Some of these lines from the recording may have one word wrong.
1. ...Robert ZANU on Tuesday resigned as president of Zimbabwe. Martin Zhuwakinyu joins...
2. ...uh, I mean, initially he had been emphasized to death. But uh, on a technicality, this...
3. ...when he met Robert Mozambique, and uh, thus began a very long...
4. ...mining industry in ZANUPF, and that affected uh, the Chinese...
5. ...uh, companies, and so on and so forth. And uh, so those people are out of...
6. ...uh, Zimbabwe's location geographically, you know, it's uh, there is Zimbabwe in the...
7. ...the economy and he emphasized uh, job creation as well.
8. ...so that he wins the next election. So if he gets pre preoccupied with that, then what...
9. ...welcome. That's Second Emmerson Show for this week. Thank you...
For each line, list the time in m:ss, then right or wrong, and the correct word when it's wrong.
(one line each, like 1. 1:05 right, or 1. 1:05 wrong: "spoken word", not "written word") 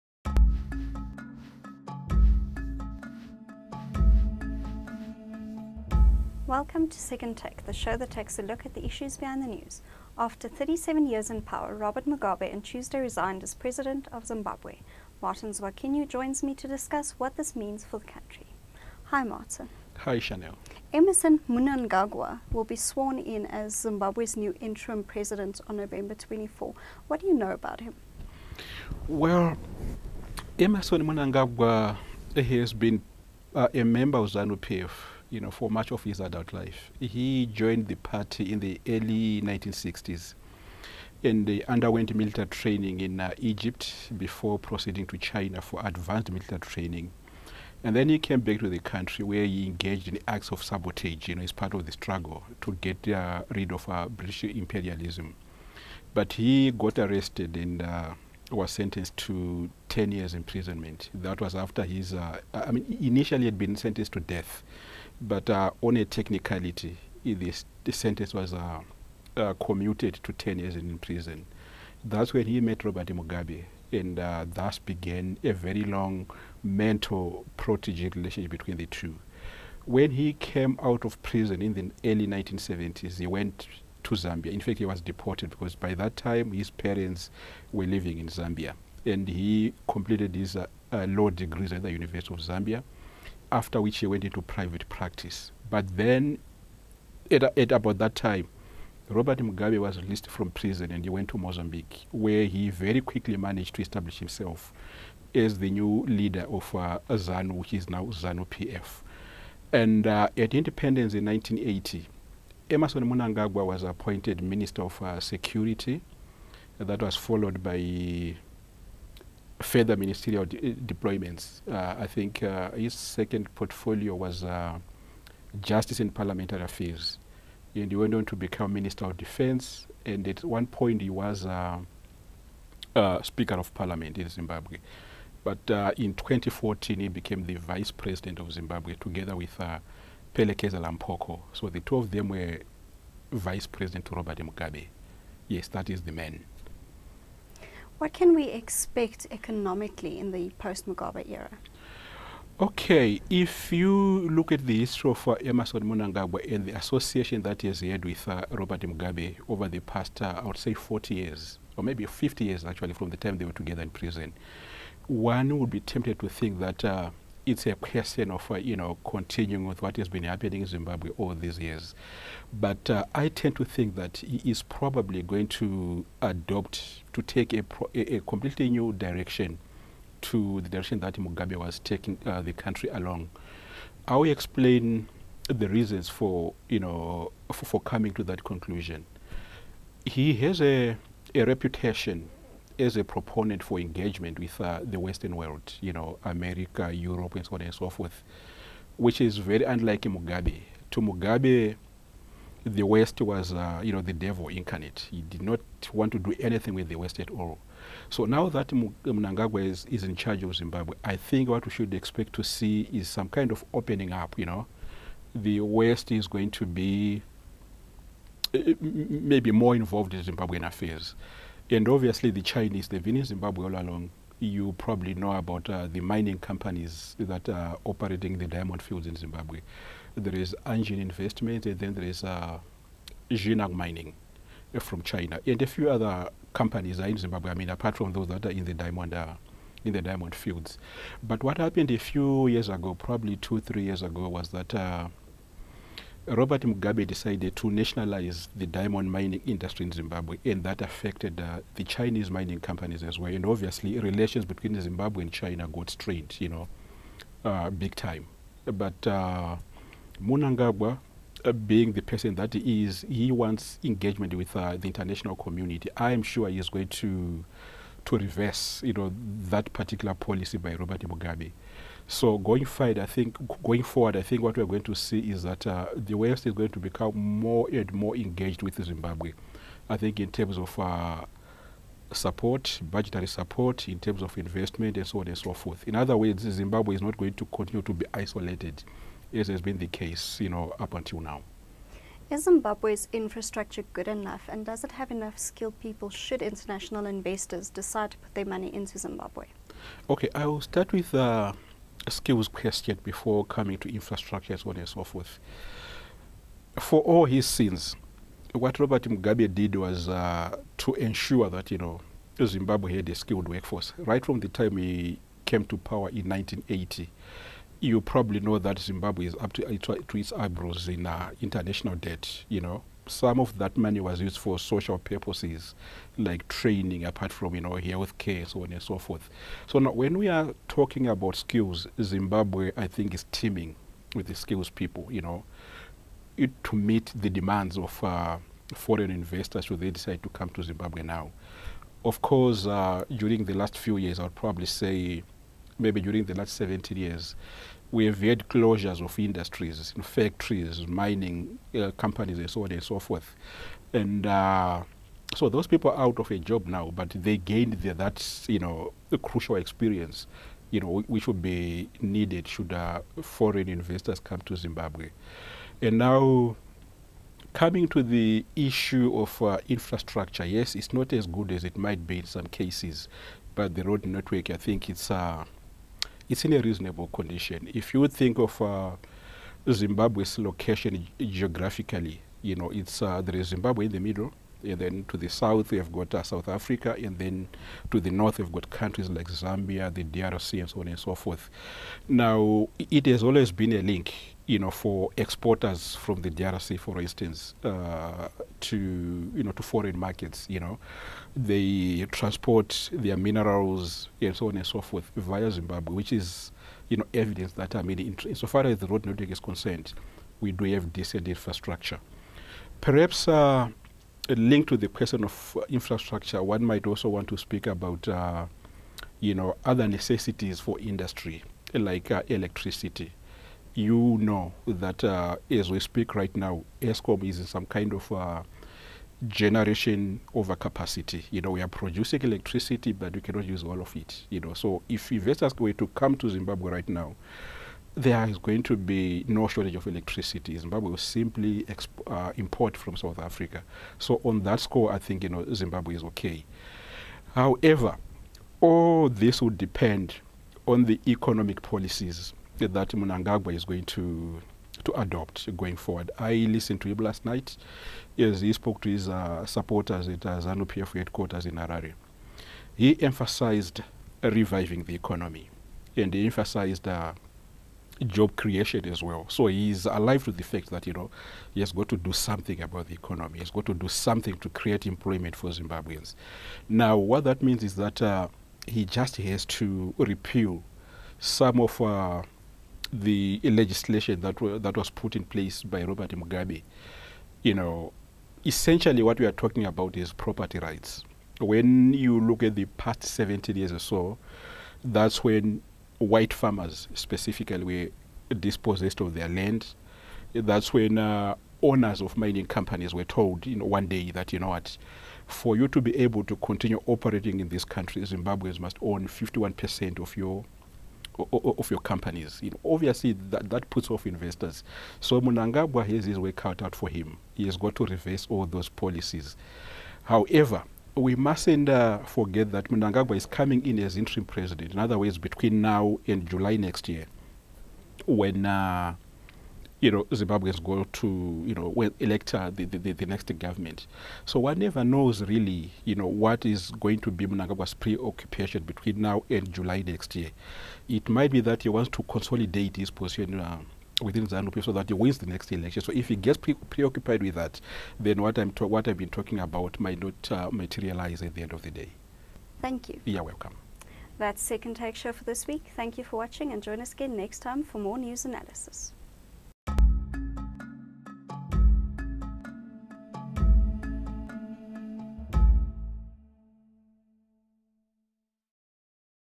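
1. 0:11 wrong: "Mugabe", not "ZANU"
2. 1:02 wrong: "sentenced", not "emphasized"
3. 1:12 wrong: "Mugabe", not "Mozambique"
4. 4:09 wrong: "Zimbabwe", not "ZANUPF"
5. 5:51 right
6. 6:18 right
7. 7:44 right
8. 9:04 right
9. 9:13 wrong: "Take", not "Emmerson".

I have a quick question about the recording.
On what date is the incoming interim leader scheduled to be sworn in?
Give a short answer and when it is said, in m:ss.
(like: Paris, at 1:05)
November 24, at 0:25.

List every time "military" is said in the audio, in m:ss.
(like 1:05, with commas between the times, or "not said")
0:42, 0:46.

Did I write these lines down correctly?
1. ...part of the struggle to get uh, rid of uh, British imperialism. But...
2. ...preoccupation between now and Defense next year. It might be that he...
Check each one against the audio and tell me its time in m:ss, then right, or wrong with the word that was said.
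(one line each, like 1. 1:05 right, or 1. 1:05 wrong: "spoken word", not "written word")
1. 0:51 right
2. 8:57 wrong: "July", not "Defense".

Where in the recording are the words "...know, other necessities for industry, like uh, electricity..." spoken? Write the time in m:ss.
6:59.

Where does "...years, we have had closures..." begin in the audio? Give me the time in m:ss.
5:46.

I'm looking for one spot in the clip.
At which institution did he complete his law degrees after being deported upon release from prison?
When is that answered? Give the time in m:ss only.
1:31.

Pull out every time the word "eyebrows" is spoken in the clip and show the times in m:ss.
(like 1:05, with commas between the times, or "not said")
5:20.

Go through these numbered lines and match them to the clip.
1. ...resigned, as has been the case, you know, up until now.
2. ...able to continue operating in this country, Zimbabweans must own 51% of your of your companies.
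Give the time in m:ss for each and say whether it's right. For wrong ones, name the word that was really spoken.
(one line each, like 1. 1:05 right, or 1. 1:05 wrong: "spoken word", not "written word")
1. 4:48 wrong: "isolated", not "resigned"
2. 8:25 right.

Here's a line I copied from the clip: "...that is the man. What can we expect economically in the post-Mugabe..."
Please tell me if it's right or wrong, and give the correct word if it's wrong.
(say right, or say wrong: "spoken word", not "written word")
right.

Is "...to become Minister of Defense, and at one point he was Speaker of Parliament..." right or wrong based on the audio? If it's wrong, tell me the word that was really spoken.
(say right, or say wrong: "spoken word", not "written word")
right.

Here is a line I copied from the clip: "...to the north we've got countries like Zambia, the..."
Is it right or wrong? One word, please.
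right.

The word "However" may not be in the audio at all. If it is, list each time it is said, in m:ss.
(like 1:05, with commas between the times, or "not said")
7:27, 8:40.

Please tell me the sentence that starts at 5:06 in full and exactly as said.
For all his sins, what Robert Mugabe did was uh, to ensure that, you know, Zimbabwe had a skilled workforce.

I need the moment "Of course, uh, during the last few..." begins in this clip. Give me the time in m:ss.
5:42.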